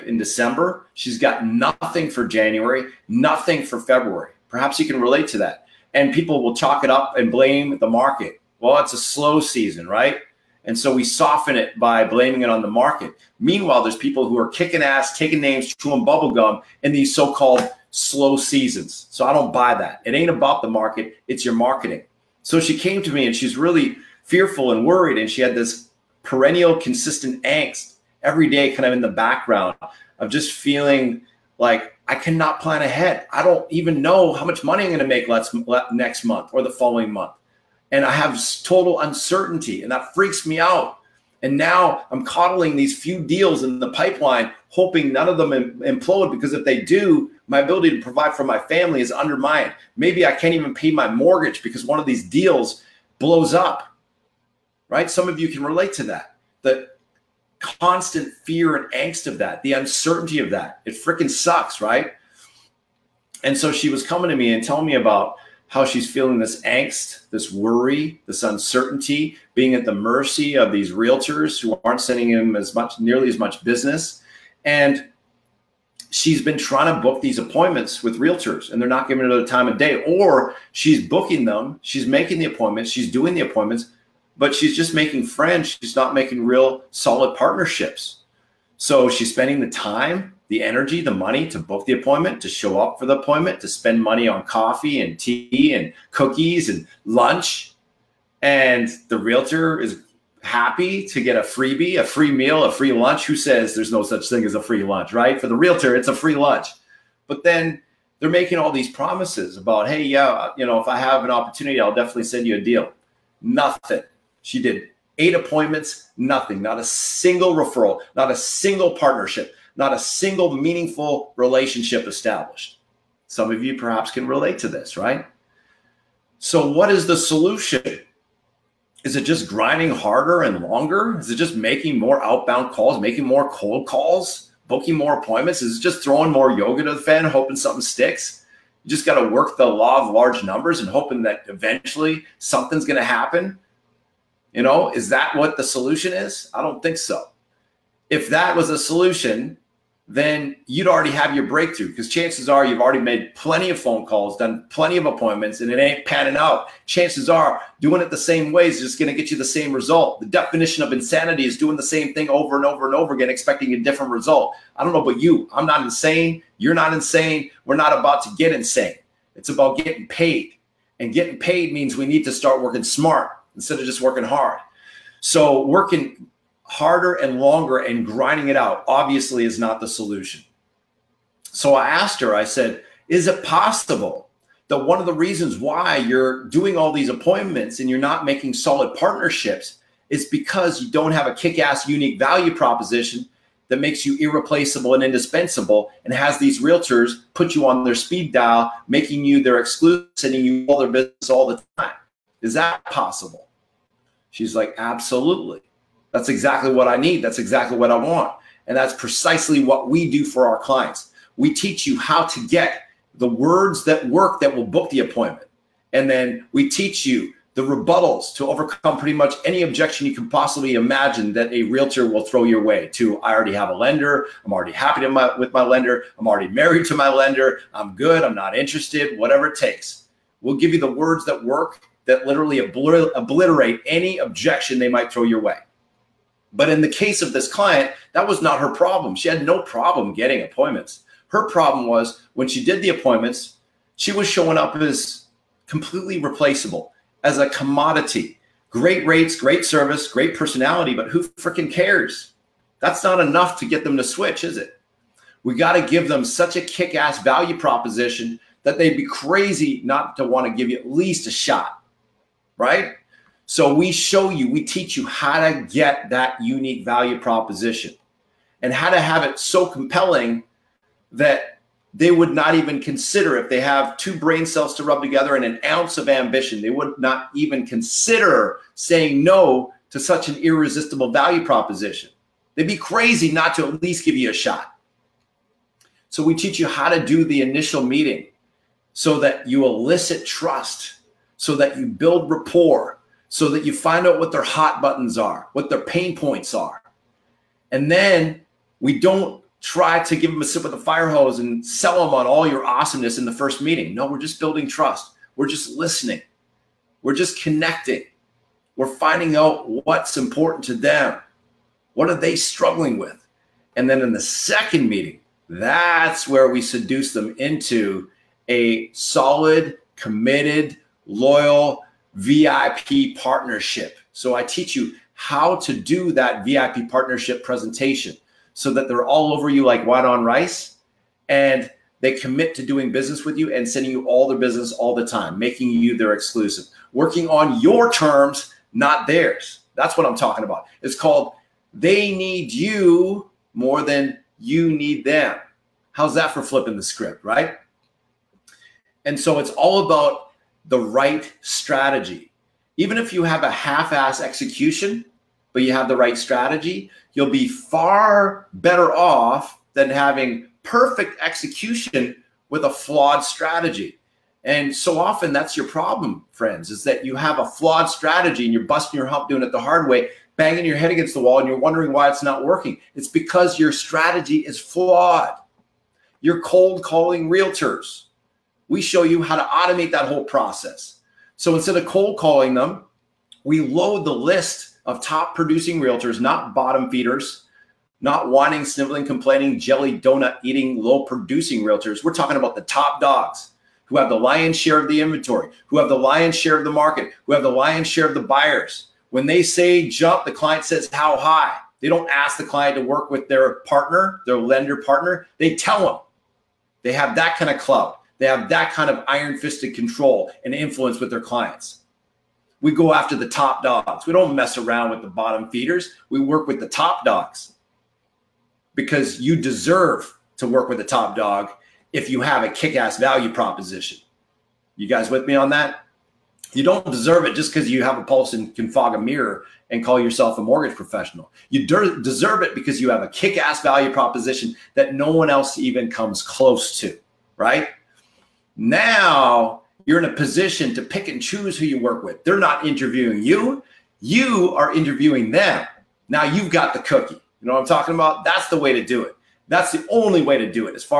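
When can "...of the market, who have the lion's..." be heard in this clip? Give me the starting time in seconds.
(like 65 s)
396 s.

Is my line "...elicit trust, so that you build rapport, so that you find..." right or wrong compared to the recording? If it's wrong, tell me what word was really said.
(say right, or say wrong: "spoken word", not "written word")
right.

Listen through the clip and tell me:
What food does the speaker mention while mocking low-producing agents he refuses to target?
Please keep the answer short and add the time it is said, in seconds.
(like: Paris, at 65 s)
Jelly donut, at 389 s.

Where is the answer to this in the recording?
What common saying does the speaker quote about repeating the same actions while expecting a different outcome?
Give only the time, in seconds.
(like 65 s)
160 s.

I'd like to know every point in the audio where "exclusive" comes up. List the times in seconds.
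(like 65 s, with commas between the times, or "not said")
199 s, 336 s.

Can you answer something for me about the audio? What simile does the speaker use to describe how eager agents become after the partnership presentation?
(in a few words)
Like white on rice.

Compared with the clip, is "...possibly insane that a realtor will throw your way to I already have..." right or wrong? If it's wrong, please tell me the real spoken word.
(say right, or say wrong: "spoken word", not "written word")
wrong: "imagine", not "insane".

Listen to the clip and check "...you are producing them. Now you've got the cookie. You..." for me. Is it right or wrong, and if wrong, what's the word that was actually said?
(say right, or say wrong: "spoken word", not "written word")
wrong: "interviewing", not "producing".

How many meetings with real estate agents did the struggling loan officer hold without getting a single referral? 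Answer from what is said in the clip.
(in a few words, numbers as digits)
8.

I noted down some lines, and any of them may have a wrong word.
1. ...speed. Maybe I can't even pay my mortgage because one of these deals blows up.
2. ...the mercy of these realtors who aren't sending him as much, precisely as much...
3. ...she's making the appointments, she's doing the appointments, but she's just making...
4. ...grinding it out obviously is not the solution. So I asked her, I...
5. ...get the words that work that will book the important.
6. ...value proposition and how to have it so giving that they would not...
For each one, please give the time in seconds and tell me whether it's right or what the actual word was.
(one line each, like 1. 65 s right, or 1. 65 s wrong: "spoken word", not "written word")
1. 49 s wrong: "undermined", not "speed"
2. 69 s wrong: "nearly", not "precisely"
3. 81 s right
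4. 178 s right
5. 212 s wrong: "appointment", not "important"
6. 266 s wrong: "compelling", not "giving".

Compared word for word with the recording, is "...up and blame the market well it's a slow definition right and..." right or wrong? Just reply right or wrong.
wrong.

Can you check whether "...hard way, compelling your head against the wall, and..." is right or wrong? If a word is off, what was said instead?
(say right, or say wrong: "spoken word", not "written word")
wrong: "banging", not "compelling".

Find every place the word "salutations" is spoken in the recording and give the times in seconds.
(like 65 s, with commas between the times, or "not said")
not said.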